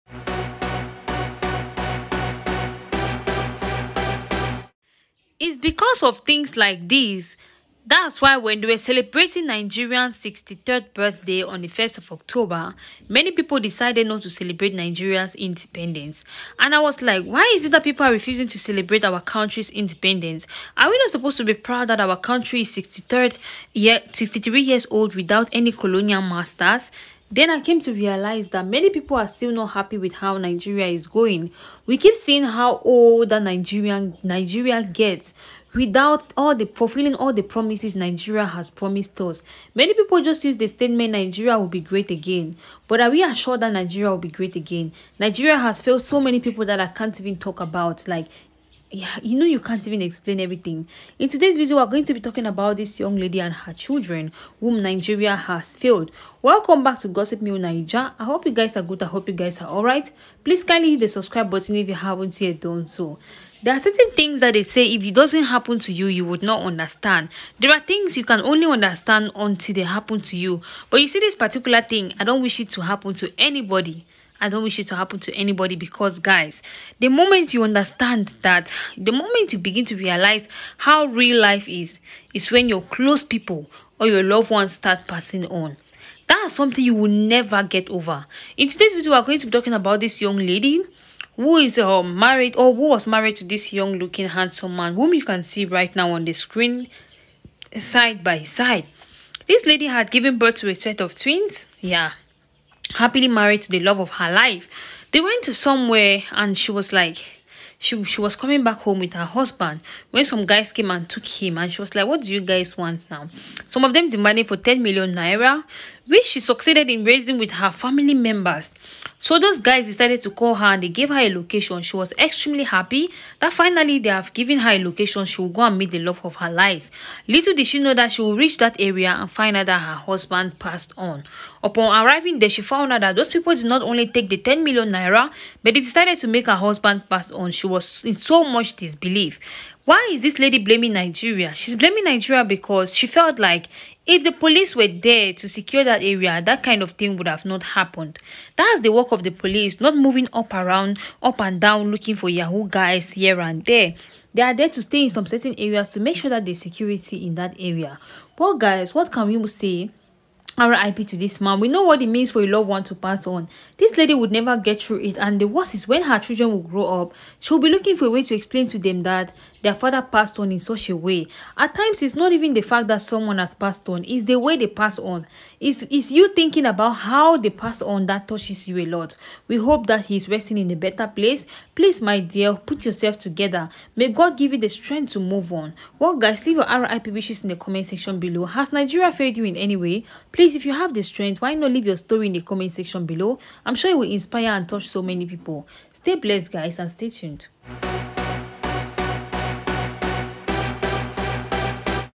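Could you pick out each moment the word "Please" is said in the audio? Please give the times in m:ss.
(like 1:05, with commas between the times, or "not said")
1:00, 3:01, 3:10.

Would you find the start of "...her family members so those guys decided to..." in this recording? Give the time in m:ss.
1:57.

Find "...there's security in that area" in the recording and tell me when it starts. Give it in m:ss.
2:36.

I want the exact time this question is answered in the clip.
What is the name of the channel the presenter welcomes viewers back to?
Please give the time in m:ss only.
0:57.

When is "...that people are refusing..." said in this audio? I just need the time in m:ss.
0:17.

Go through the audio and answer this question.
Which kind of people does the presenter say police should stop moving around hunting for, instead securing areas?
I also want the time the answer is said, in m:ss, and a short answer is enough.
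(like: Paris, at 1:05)
Yahoo guys, at 2:32.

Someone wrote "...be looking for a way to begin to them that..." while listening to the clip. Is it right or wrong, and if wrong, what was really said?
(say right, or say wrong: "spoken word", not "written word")
wrong: "explain", not "begin".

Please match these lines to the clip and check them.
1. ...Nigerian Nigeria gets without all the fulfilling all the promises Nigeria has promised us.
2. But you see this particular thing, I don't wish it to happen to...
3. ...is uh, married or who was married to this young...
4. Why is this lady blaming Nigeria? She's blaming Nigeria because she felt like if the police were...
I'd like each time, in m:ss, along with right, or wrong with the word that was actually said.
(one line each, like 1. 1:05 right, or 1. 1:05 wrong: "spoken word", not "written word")
1. 0:33 right
2. 1:10 right
3. 1:31 right
4. 2:19 right.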